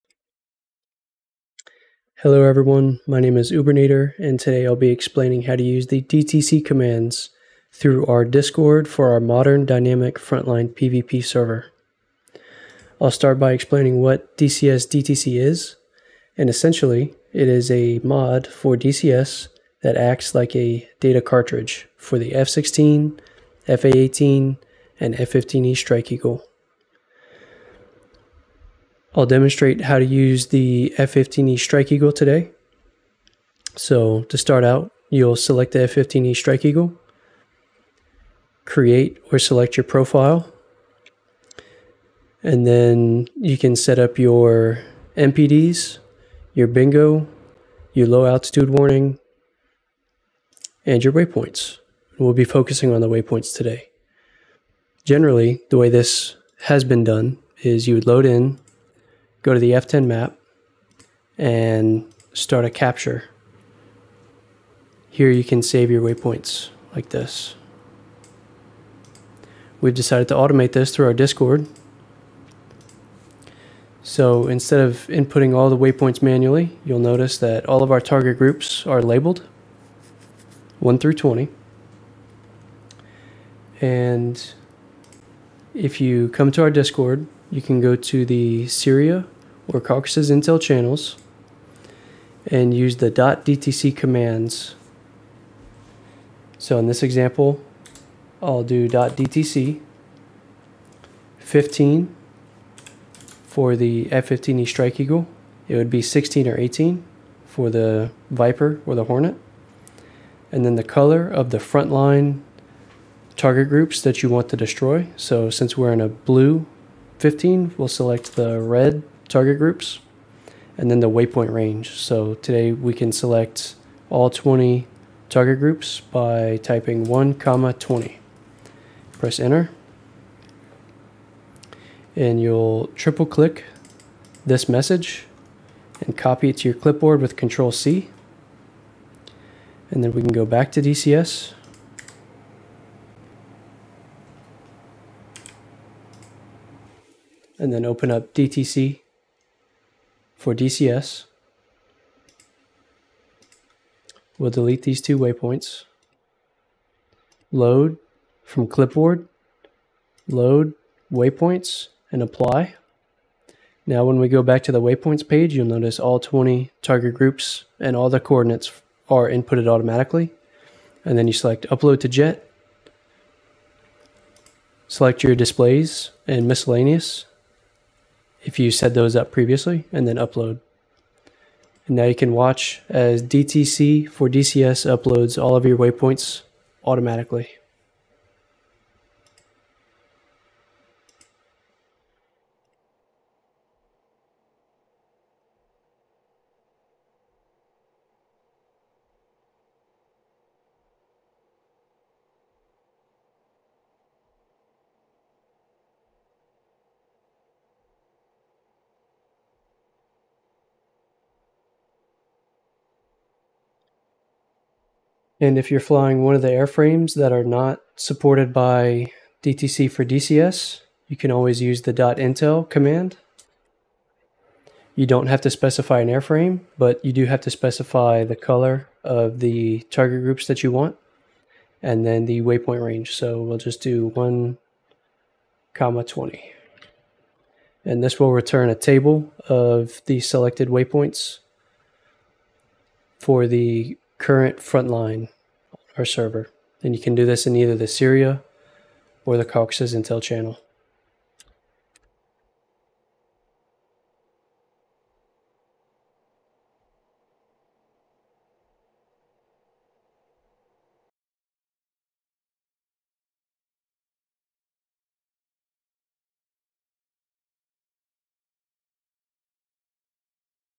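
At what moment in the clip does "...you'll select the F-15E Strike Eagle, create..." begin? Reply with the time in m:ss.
0:35.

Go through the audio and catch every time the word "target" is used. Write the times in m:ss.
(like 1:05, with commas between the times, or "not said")
1:18, 1:53, 1:59, 2:05, 2:46, 3:49.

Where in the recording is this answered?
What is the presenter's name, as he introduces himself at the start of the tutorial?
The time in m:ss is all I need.
0:03.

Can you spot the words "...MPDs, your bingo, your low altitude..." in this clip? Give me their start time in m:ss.
0:45.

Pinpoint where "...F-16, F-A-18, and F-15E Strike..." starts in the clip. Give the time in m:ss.
0:22.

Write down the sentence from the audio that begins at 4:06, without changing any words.
And you can do this in either the Syria or the Caucasus Intel channel.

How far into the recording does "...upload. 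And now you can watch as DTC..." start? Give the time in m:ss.
3:00.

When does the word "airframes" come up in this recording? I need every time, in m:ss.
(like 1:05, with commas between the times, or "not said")
3:36, 3:46.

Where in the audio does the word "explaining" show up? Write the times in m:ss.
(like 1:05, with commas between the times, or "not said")
0:04, 0:13.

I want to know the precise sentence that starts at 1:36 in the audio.
So in this example, I'll do .dtc 15 for the F-15E Strike Eagle.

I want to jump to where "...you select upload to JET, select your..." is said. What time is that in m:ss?
2:51.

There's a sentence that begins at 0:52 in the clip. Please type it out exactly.
We'll be focusing on the waypoints today.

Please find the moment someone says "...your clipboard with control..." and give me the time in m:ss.
2:16.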